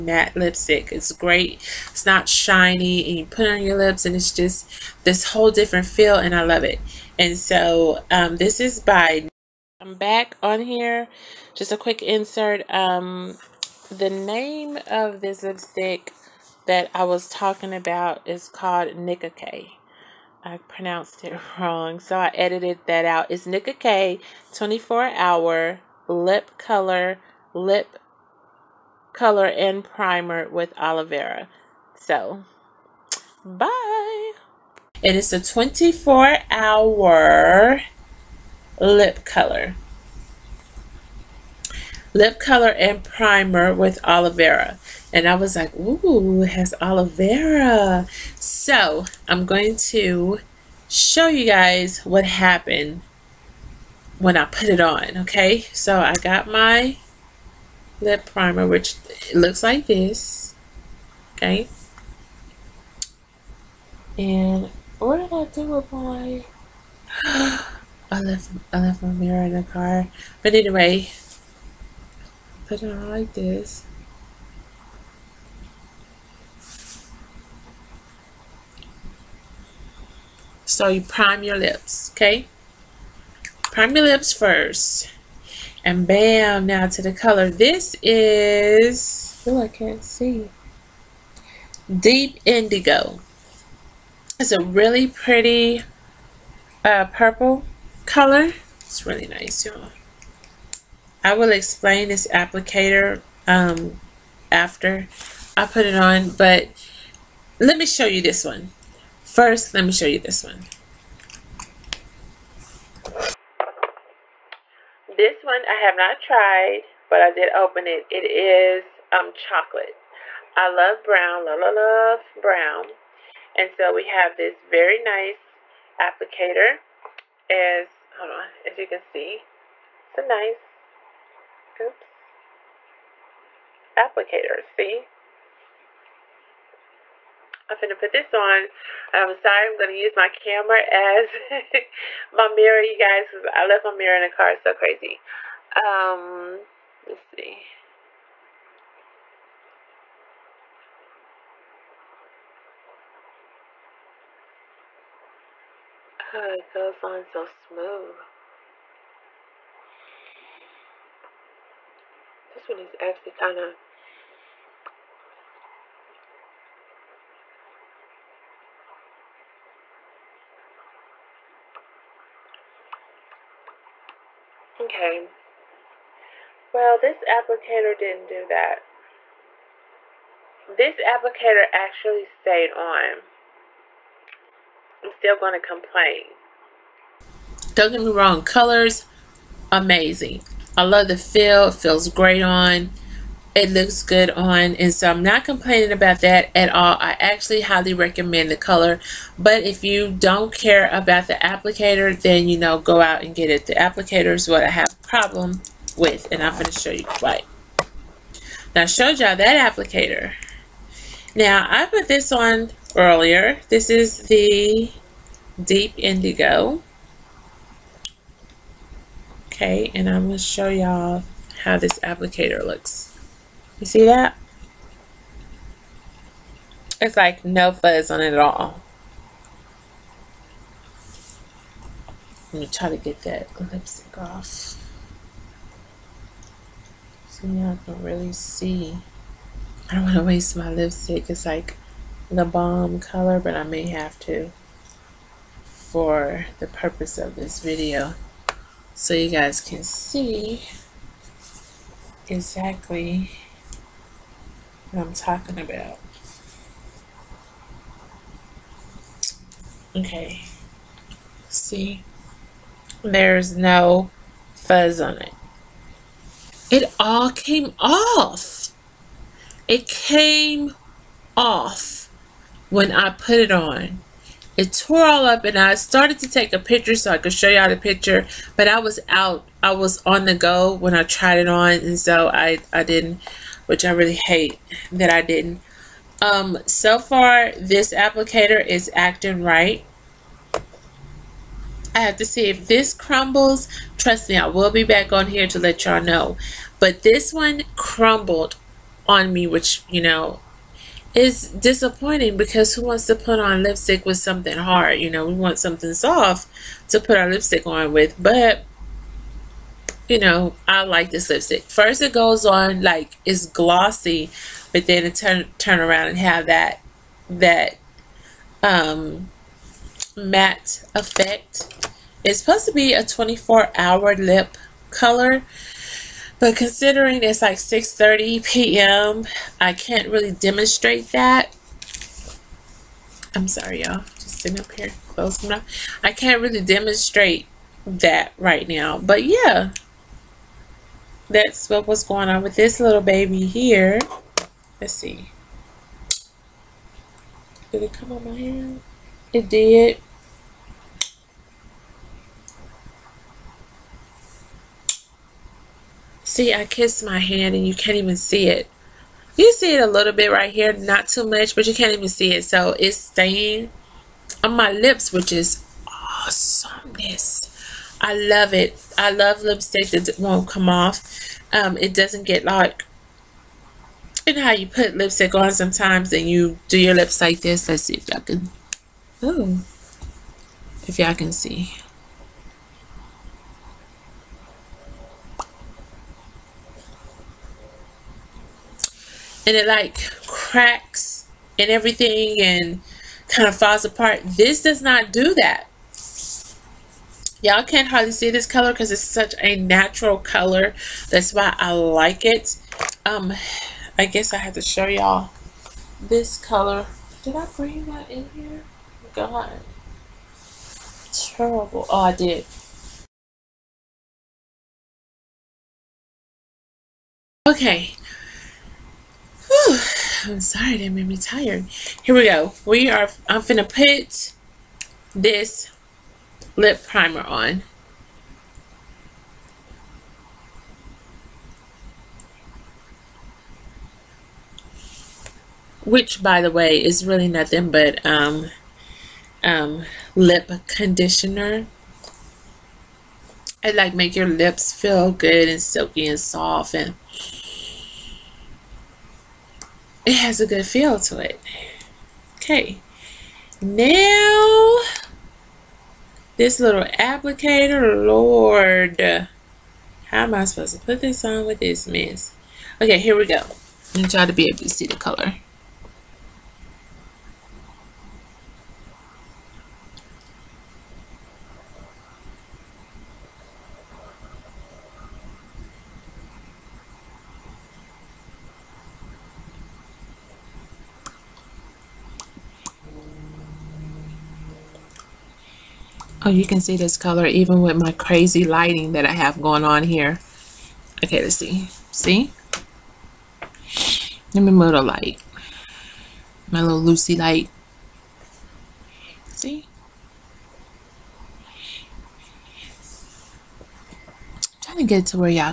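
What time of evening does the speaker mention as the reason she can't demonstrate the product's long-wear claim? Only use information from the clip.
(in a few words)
6:30 p.m.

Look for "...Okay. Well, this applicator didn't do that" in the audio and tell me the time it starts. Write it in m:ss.
2:54.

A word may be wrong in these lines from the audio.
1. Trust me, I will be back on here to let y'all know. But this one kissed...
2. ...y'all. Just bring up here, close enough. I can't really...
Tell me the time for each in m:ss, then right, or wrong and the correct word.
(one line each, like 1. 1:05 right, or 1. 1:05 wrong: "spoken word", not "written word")
1. 4:53 wrong: "crumbled", not "kissed"
2. 5:33 wrong: "sitting", not "bring".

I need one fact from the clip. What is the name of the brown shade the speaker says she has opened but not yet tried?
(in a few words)
chocolate.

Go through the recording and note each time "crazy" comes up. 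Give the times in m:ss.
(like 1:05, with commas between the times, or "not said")
2:24, 8:07.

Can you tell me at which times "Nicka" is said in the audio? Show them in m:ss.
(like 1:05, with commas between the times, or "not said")
0:18, 0:23.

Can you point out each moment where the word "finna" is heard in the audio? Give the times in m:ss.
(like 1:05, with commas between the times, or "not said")
2:17, 7:03.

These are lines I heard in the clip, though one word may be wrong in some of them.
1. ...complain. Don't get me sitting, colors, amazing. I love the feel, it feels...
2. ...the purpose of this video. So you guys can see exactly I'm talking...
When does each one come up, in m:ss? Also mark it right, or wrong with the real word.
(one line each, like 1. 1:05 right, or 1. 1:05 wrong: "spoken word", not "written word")
1. 3:05 wrong: "wrong", not "sitting"
2. 4:06 right.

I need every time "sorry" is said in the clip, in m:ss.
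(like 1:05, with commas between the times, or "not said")
2:19, 5:33, 7:00.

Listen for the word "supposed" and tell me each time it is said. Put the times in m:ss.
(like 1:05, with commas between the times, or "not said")
5:22, 7:40.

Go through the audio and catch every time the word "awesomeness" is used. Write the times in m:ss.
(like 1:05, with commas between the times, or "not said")
6:06.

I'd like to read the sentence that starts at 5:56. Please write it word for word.
See, I kissed my hand and you can't even see it.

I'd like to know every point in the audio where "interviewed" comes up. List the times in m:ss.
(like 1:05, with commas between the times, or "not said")
not said.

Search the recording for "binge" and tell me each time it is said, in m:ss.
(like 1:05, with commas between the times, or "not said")
not said.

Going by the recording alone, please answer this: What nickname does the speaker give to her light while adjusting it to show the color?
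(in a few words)
Lucy light.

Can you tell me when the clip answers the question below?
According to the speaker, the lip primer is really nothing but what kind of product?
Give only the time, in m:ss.
7:20.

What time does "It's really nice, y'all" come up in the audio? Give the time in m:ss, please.
1:38.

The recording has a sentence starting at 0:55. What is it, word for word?
So I got my lip primer, which looks like this, okay?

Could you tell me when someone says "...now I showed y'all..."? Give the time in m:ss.
3:28.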